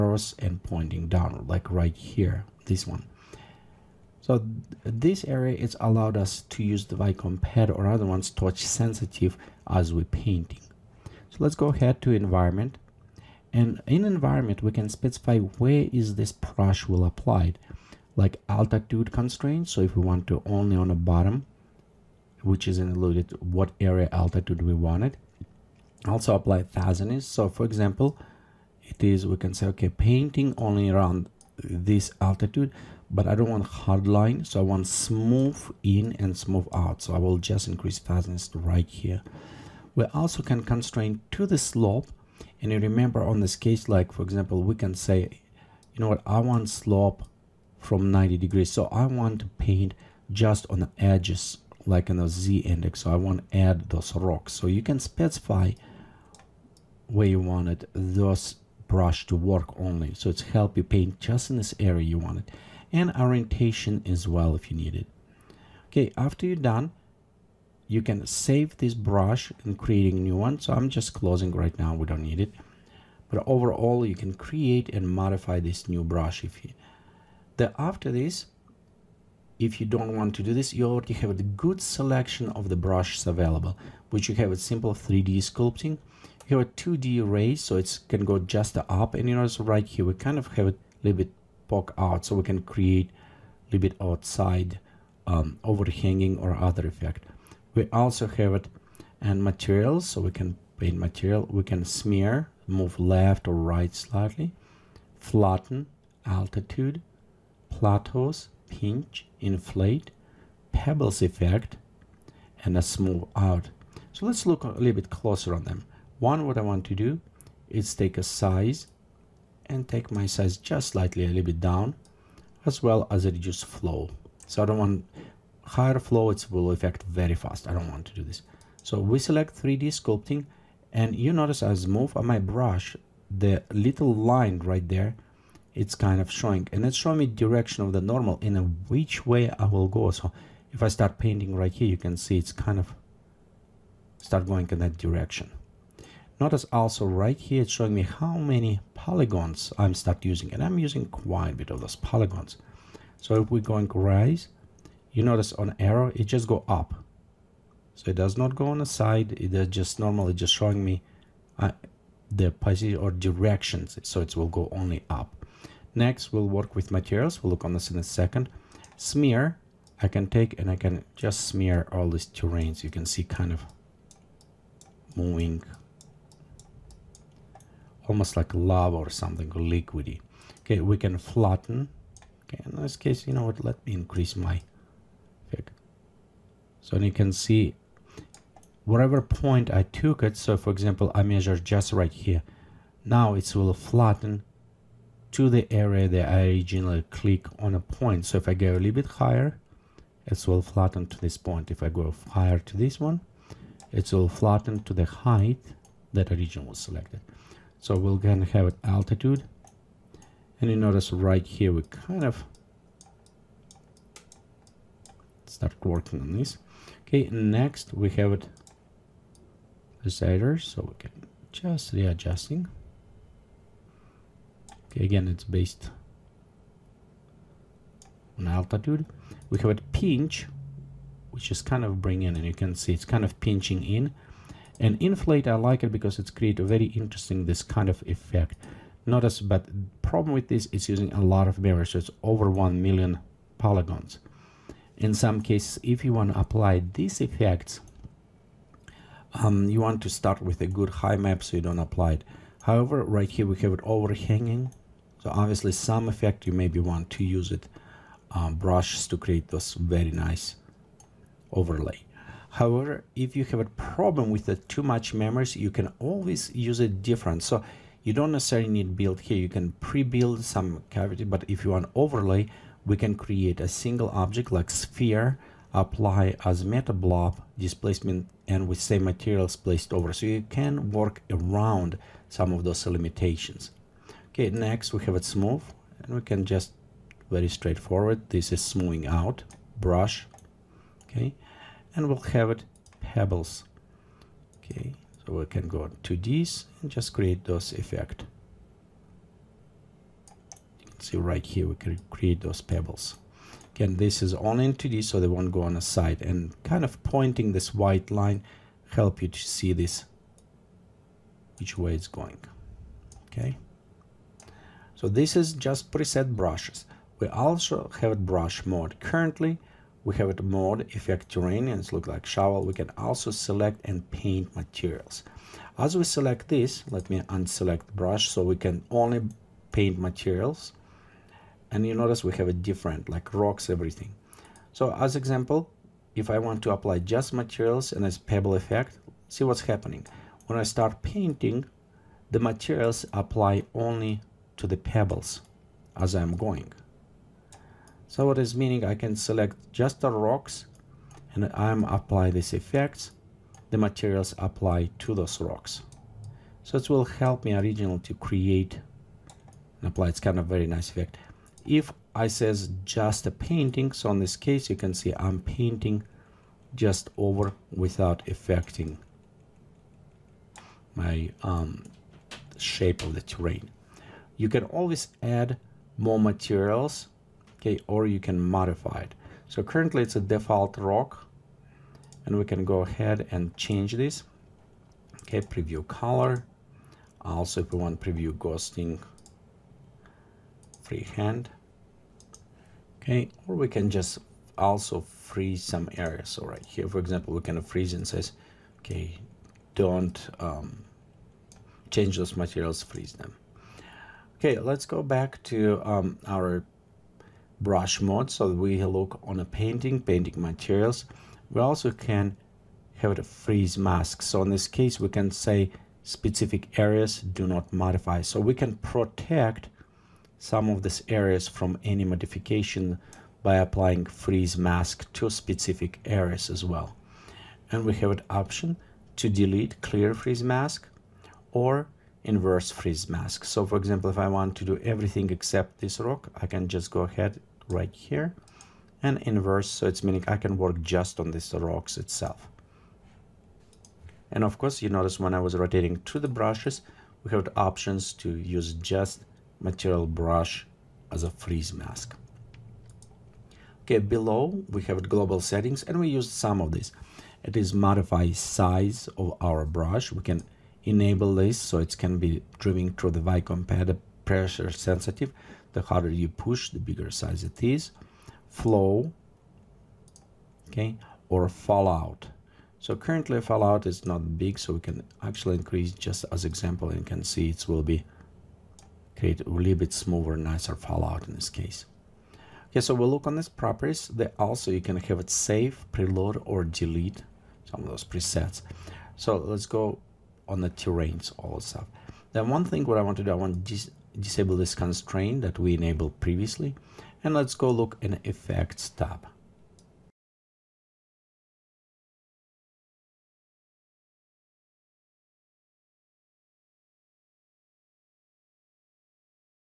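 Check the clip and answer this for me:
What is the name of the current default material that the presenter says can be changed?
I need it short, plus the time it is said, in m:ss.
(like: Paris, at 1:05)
default rock, at 6:20.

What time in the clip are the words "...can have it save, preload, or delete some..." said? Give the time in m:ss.
8:04.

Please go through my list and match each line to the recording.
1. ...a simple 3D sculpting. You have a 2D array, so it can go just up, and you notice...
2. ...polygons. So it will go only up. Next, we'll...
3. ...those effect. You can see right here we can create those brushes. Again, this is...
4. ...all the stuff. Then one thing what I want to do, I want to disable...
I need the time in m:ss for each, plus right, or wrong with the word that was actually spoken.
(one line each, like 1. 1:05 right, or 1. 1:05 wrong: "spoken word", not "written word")
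1. 1:24 right
2. 2:43 wrong: "directions", not "polygons"
3. 4:57 wrong: "pebbles", not "brushes"
4. 8:11 right.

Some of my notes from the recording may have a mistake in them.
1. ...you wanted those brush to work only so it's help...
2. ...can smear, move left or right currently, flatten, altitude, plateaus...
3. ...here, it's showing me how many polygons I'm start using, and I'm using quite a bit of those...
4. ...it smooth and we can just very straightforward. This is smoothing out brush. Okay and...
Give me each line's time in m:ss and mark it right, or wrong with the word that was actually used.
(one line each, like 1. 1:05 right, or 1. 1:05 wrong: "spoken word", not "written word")
1. 0:57 right
2. 1:41 wrong: "slightly", not "currently"
3. 2:27 right
4. 4:45 right.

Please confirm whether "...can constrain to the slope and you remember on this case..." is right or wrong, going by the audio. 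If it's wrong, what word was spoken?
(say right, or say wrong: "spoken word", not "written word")
right.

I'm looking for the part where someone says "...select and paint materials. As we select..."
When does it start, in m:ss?
5:23.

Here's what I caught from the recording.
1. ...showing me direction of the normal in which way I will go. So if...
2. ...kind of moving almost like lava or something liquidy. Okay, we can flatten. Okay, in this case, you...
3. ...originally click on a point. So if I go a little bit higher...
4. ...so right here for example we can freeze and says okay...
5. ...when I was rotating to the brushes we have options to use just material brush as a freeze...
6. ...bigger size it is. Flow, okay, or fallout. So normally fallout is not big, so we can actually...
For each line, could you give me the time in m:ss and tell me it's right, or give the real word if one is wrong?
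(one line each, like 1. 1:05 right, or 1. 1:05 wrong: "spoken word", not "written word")
1. 2:16 right
2. 2:53 right
3. 3:16 right
4. 6:36 right
5. 7:25 right
6. 7:46 wrong: "currently", not "normally".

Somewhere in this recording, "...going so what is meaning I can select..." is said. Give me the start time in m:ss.
5:46.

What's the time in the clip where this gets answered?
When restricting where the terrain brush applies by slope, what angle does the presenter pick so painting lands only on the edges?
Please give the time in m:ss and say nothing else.
0:48.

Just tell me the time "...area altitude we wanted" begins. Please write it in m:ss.
0:23.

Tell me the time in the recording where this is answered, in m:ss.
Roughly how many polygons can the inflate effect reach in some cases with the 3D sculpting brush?
4:02.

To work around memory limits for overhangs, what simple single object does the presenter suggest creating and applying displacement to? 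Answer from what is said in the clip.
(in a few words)
sphere.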